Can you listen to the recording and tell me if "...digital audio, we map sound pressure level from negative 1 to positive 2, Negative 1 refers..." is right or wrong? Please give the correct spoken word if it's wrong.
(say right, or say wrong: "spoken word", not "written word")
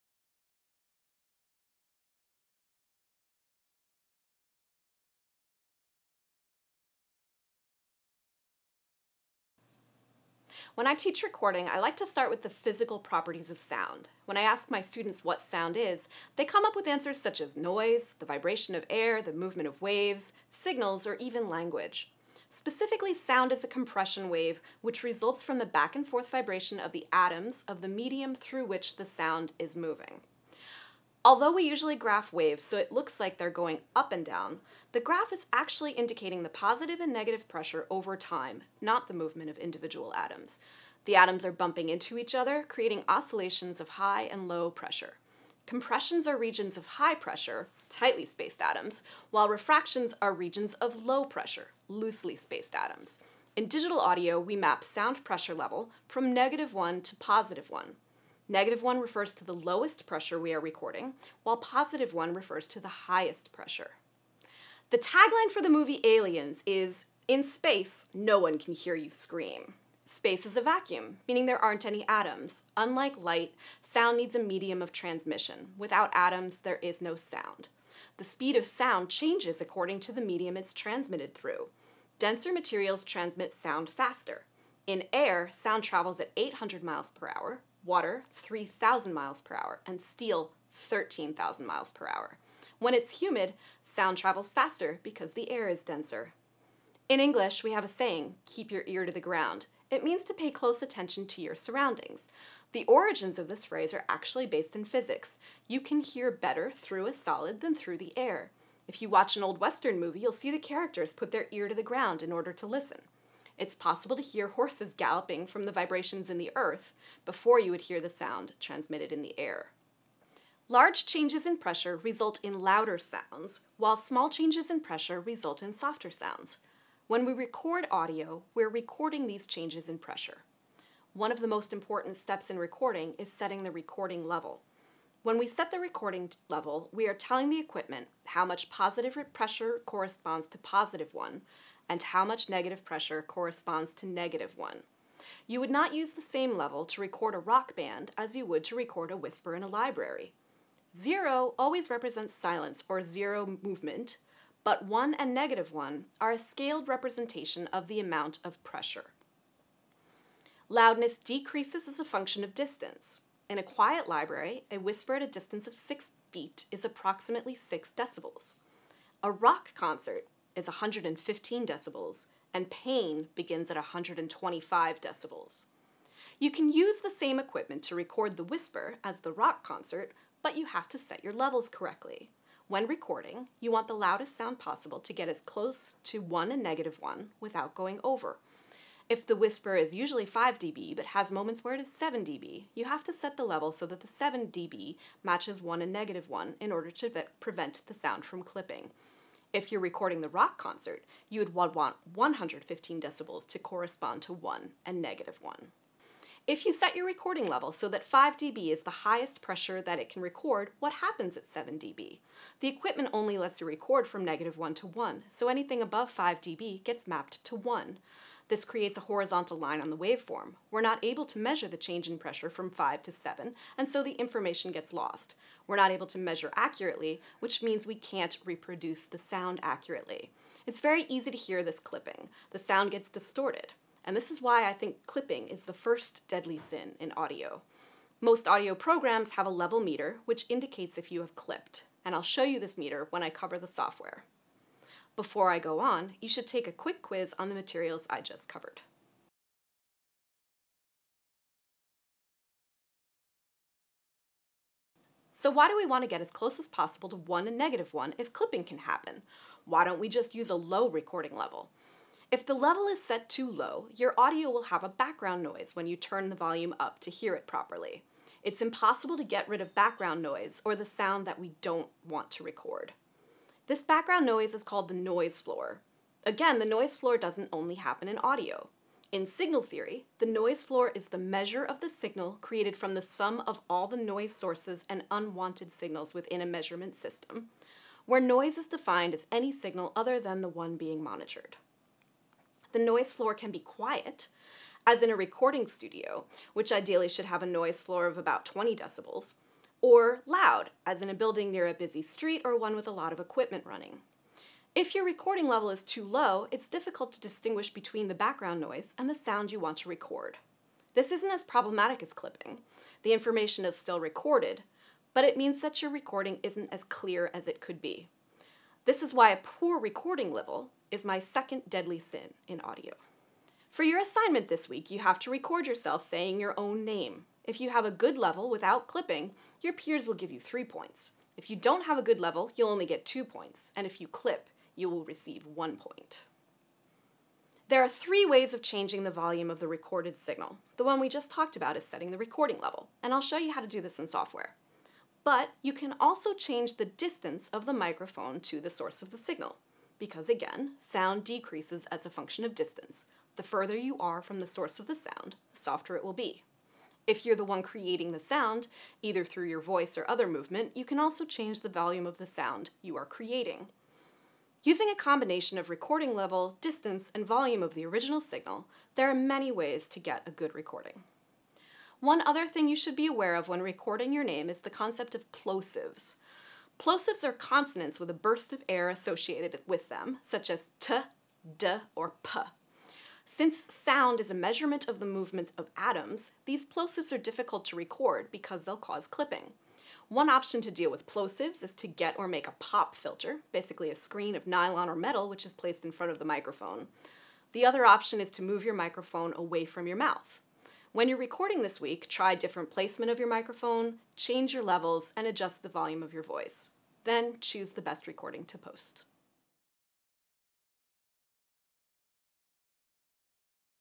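wrong: "1", not "2".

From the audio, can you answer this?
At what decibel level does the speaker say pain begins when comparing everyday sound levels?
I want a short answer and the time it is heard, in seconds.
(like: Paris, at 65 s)
125 decibels, at 173 s.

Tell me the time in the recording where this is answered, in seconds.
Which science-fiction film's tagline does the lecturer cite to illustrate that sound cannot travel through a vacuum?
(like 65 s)
66 s.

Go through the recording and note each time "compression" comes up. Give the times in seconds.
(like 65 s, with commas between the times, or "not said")
23 s, 45 s.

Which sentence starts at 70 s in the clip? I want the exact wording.
Space is a vacuum, meaning there aren't any atoms.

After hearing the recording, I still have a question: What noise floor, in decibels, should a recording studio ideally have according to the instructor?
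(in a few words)
20 decibels.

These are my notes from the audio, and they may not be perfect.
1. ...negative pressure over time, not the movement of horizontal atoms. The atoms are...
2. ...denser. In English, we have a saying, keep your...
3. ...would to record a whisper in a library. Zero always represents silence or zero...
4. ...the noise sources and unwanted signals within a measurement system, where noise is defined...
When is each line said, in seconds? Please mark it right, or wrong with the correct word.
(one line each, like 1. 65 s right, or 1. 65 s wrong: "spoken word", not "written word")
1. 37 s wrong: "individual", not "horizontal"
2. 95 s right
3. 148 s right
4. 283 s right.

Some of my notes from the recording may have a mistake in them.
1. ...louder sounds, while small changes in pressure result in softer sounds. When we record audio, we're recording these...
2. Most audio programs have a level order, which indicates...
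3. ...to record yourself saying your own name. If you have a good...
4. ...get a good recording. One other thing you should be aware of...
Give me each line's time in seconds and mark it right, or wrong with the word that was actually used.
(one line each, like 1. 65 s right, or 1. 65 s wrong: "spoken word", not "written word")
1. 122 s right
2. 238 s wrong: "meter", not "order"
3. 325 s right
4. 369 s right.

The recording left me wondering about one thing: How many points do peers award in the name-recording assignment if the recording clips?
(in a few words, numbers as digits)
1 point.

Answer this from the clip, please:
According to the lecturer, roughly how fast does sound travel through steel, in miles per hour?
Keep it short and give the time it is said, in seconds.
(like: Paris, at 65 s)
13,000 miles per hour, at 90 s.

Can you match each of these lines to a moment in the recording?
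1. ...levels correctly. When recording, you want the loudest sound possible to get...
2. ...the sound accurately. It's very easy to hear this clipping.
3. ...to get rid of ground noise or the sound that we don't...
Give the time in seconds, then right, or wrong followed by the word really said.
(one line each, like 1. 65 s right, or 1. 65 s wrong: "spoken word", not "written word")
1. 181 s right
2. 229 s right
3. 269 s wrong: "background", not "ground".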